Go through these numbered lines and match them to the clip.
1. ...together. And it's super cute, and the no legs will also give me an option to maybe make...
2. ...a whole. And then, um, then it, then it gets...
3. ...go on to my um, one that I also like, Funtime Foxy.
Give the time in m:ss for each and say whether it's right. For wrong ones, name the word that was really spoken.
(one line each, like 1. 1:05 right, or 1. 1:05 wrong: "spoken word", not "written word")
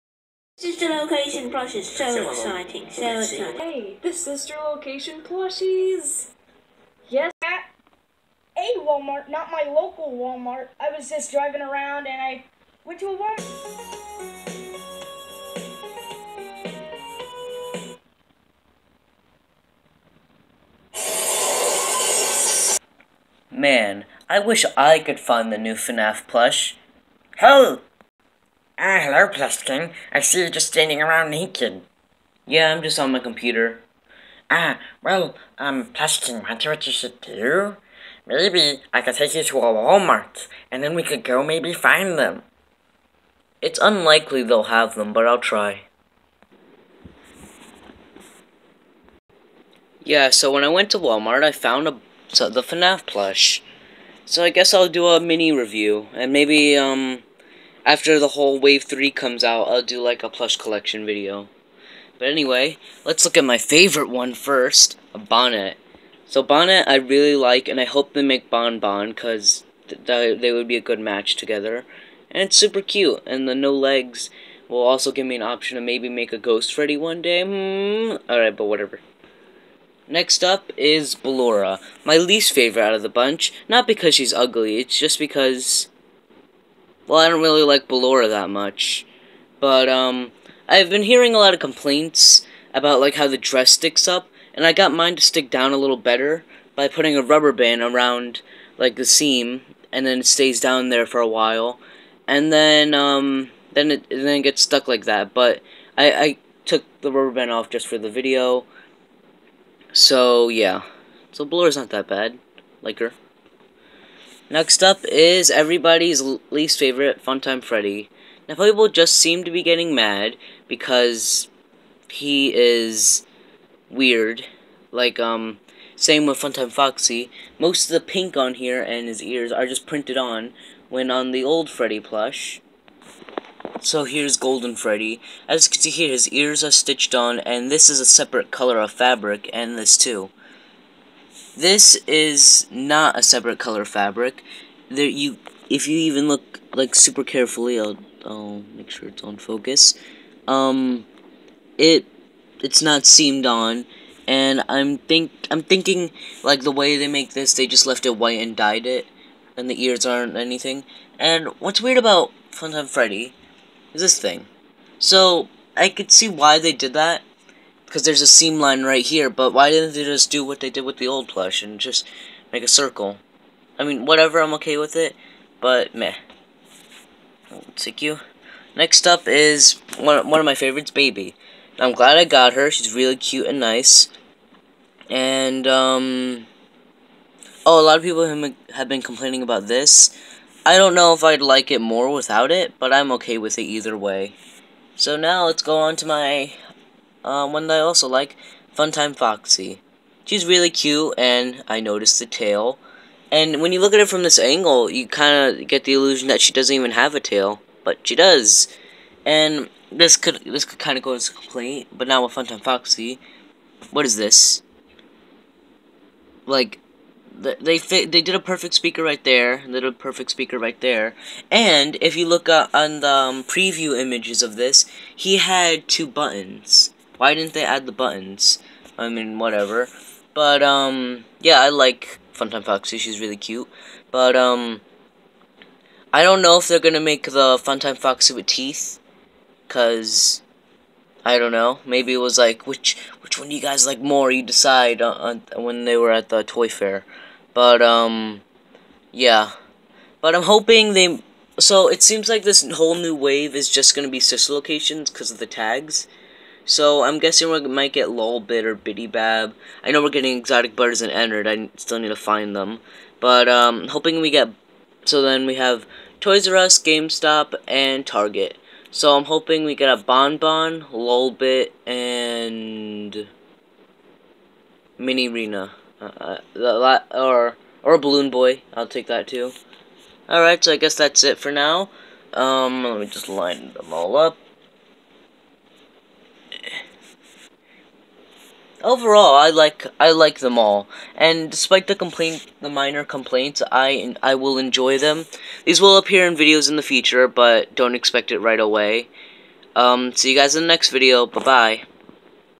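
1. 1:11 right
2. 1:41 wrong: "while", not "whole"
3. 3:15 right.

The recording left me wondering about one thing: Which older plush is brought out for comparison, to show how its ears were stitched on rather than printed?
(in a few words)
Golden Freddy.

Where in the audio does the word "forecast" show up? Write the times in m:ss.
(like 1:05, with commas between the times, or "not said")
not said.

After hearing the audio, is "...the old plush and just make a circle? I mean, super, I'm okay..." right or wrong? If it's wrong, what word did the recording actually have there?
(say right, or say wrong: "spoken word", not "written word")
wrong: "whatever", not "super".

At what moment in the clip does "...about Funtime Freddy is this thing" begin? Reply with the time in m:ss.
2:41.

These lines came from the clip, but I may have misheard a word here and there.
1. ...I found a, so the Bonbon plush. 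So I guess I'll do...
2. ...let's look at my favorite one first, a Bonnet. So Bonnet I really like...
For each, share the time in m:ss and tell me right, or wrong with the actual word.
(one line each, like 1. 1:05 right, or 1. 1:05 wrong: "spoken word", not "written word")
1. 0:51 wrong: "FNAF", not "Bonbon"
2. 1:03 right.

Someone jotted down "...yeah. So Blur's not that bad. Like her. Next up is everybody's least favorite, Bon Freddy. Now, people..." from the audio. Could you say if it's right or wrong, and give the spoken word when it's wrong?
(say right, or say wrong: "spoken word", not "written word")
wrong: "Funtime", not "Bon".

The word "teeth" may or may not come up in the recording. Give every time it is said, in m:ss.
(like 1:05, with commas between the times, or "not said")
3:58.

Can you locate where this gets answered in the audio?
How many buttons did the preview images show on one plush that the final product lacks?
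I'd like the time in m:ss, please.
3:45.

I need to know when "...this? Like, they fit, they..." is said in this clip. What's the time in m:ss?
3:34.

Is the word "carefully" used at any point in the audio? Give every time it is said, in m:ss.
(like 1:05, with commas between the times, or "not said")
2:27.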